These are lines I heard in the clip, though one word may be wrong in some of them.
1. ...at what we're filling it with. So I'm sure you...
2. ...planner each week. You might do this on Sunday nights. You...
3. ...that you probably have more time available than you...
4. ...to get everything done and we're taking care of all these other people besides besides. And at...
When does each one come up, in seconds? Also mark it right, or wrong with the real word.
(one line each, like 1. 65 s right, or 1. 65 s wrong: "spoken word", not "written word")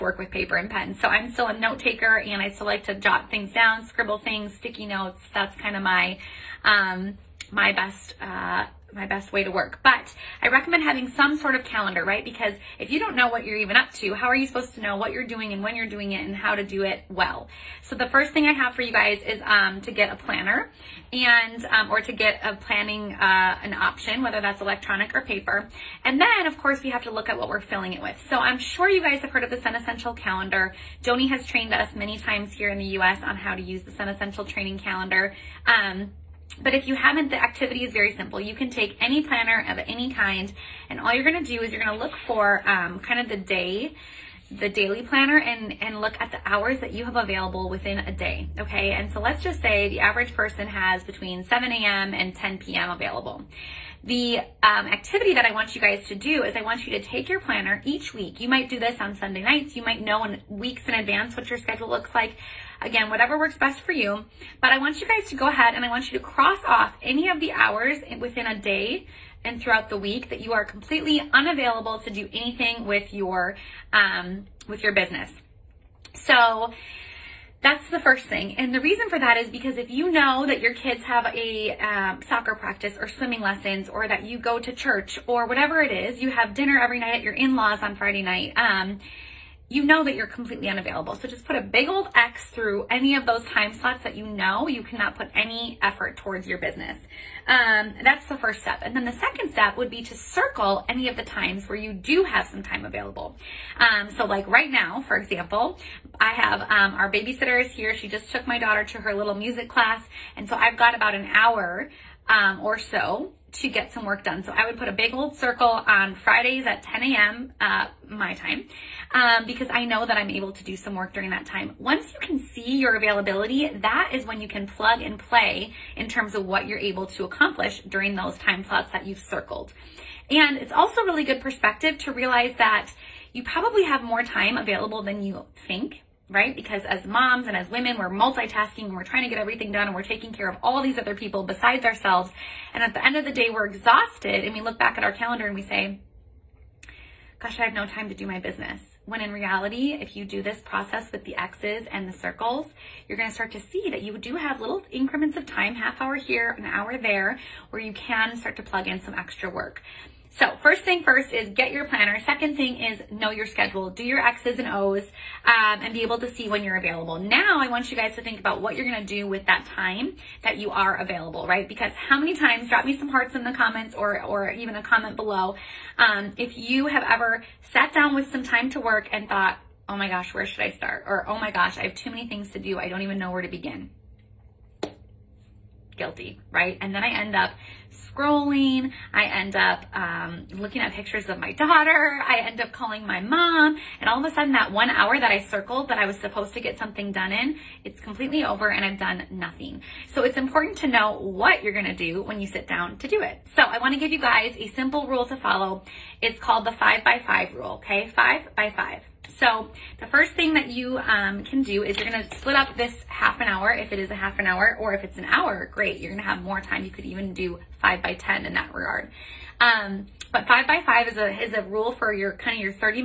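1. 27 s right
2. 57 s right
3. 132 s right
4. 139 s wrong: "ourselves", not "besides".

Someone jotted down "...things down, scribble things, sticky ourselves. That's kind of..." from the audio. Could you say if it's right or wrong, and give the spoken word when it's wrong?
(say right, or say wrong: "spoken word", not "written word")
wrong: "notes", not "ourselves".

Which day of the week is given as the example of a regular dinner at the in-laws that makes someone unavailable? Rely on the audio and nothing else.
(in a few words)
Friday.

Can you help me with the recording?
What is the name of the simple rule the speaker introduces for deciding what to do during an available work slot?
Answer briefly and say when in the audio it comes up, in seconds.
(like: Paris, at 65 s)
five by five rule, at 206 s.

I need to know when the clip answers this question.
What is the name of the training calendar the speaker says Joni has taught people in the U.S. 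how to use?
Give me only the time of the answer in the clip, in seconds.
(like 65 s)
33 s.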